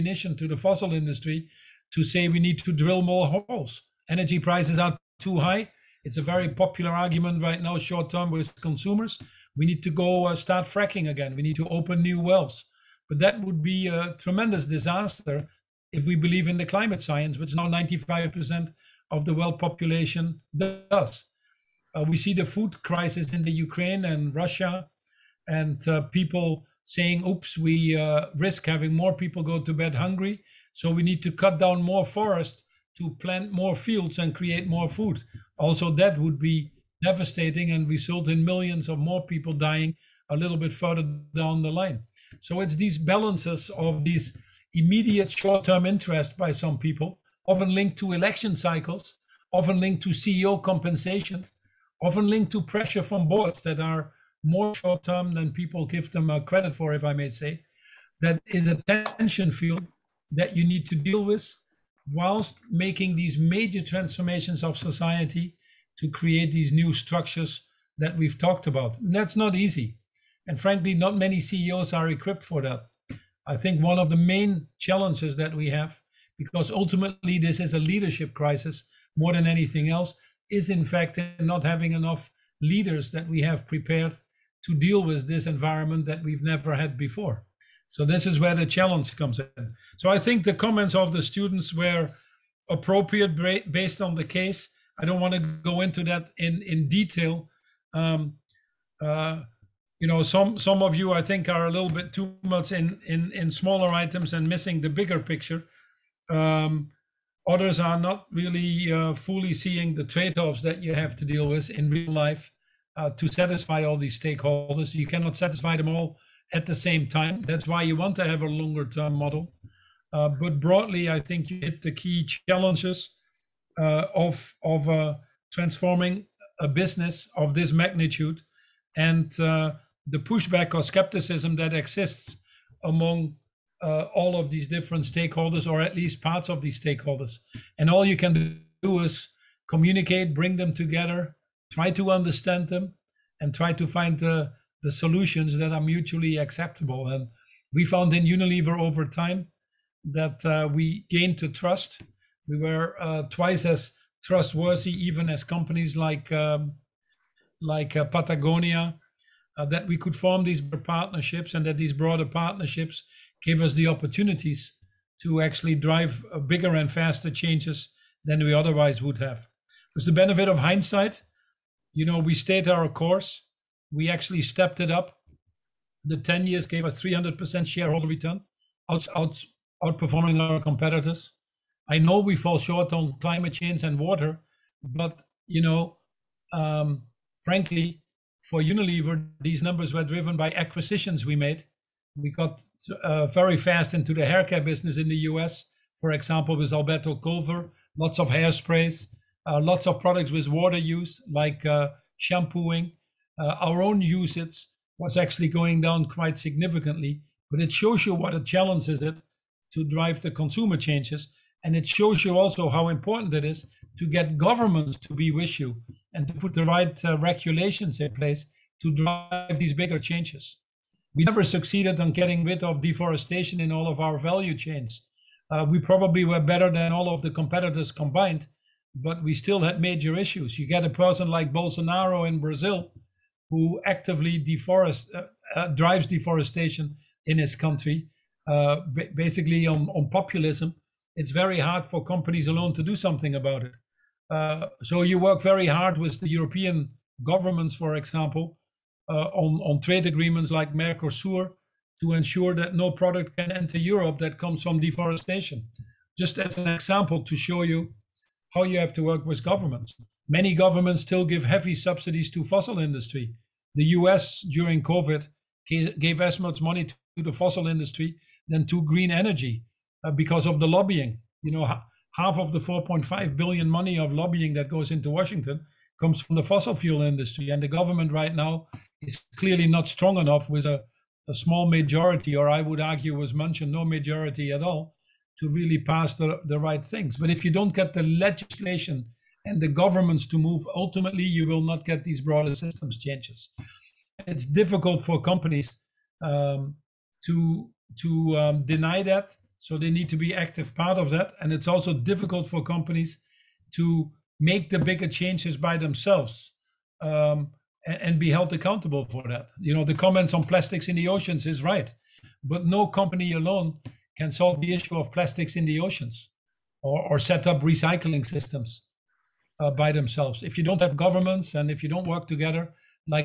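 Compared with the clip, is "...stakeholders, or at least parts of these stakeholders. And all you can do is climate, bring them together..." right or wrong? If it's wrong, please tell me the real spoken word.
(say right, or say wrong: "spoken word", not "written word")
wrong: "communicate", not "climate".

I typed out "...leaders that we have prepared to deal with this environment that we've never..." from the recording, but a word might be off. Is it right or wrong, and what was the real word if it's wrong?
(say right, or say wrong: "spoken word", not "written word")
right.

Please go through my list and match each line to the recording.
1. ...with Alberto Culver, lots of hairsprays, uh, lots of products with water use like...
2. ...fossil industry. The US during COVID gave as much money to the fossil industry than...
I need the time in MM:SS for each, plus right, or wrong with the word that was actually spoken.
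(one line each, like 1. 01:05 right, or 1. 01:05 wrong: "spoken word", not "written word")
1. 03:16 right
2. 04:22 right.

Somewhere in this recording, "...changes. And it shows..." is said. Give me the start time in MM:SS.
03:30.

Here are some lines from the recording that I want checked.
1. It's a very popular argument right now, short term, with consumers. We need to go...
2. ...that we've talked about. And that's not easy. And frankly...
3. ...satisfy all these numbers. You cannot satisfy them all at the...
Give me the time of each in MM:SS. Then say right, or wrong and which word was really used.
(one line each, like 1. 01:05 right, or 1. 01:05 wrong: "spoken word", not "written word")
1. 00:06 right
2. 01:07 right
3. 01:53 wrong: "stakeholders", not "numbers".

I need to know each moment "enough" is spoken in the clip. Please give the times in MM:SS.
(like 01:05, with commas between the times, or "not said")
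01:21, 04:40.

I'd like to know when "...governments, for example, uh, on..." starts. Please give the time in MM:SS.
04:07.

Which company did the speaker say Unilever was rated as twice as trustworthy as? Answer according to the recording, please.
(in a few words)
Patagonia.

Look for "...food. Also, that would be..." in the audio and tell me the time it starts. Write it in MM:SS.
00:34.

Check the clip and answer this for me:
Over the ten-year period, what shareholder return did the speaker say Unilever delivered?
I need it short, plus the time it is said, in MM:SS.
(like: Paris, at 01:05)
300%, at 02:57.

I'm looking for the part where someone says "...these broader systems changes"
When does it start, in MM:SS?
04:52.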